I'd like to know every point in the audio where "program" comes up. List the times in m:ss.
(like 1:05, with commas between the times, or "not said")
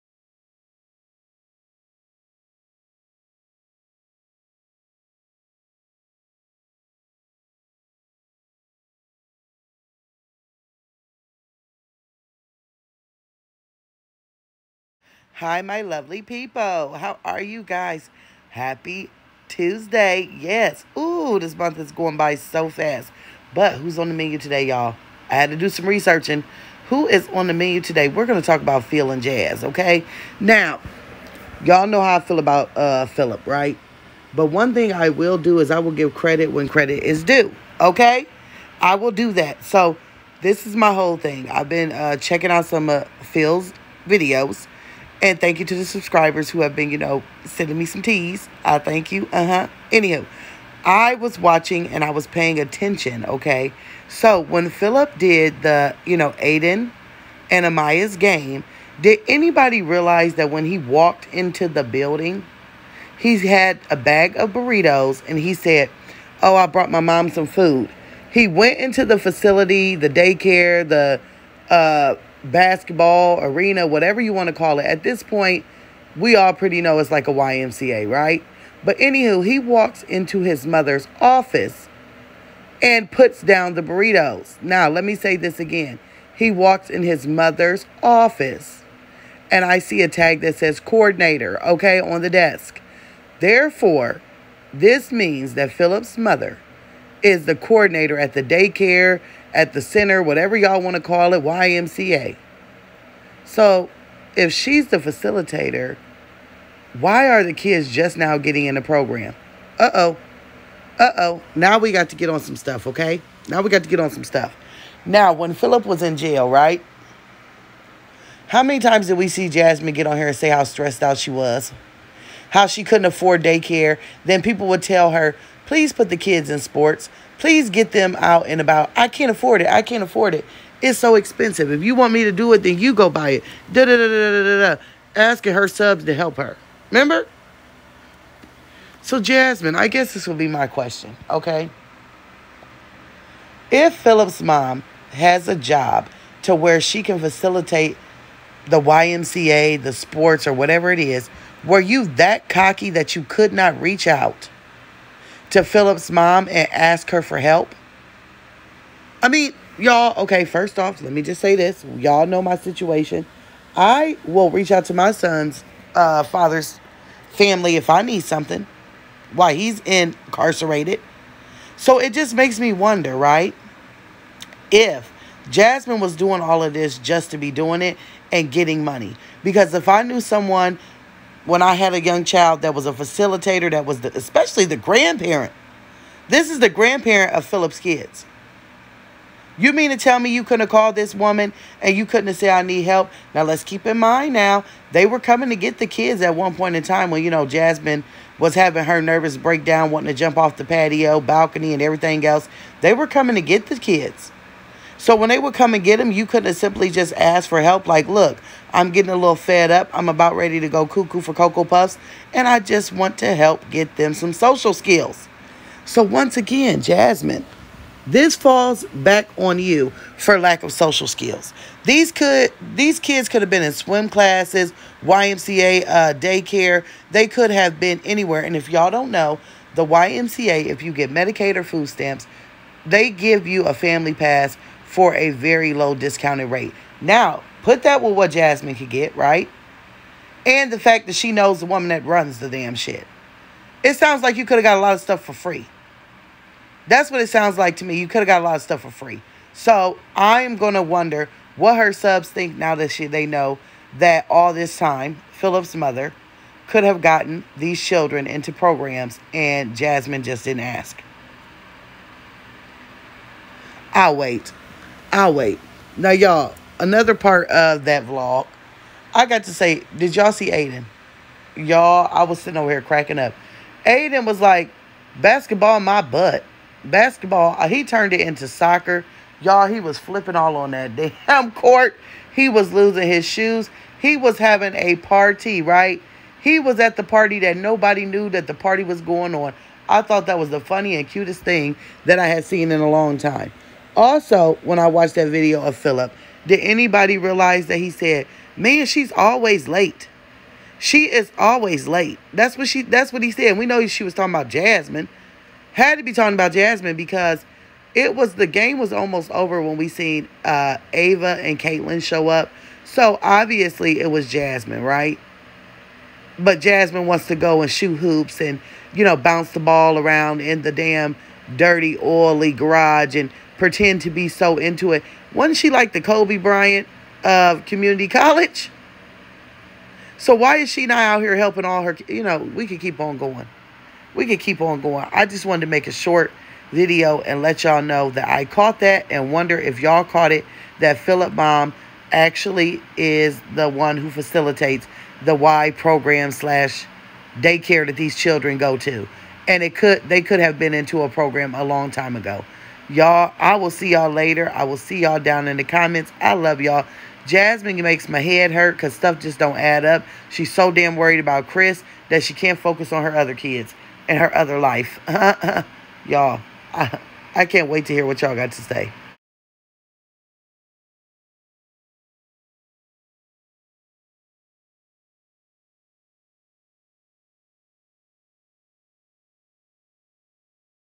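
1:48, 4:18, 5:45, 5:51.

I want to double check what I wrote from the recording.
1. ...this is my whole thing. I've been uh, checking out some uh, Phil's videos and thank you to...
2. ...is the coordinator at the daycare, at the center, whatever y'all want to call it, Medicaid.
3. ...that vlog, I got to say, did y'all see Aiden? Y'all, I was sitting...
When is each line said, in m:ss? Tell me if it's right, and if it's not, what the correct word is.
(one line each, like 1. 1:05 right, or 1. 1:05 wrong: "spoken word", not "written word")
1. 0:40 right
2. 1:37 wrong: "YMCA", not "Medicaid"
3. 4:27 right.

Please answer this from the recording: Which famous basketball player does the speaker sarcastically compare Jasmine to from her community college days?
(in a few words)
Kobe Bryant.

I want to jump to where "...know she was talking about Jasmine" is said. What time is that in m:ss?
5:03.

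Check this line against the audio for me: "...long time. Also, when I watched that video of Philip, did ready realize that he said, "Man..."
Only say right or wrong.
wrong.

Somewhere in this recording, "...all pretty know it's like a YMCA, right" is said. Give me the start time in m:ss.
1:16.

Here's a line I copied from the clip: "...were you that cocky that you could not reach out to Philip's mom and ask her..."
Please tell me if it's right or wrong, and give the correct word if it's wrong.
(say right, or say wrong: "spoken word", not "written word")
right.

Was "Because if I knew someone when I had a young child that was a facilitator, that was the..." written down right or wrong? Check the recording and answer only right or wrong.
right.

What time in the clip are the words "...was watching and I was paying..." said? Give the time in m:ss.
0:51.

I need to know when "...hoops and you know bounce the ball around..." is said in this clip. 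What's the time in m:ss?
5:17.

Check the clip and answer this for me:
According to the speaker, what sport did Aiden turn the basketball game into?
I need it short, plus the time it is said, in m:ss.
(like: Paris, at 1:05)
Soccer, at 4:38.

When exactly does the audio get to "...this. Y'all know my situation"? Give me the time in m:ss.
2:41.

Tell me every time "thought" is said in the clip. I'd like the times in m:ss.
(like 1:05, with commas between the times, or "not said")
4:50.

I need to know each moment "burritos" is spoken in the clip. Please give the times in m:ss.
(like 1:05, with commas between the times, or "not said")
1:04, 1:23.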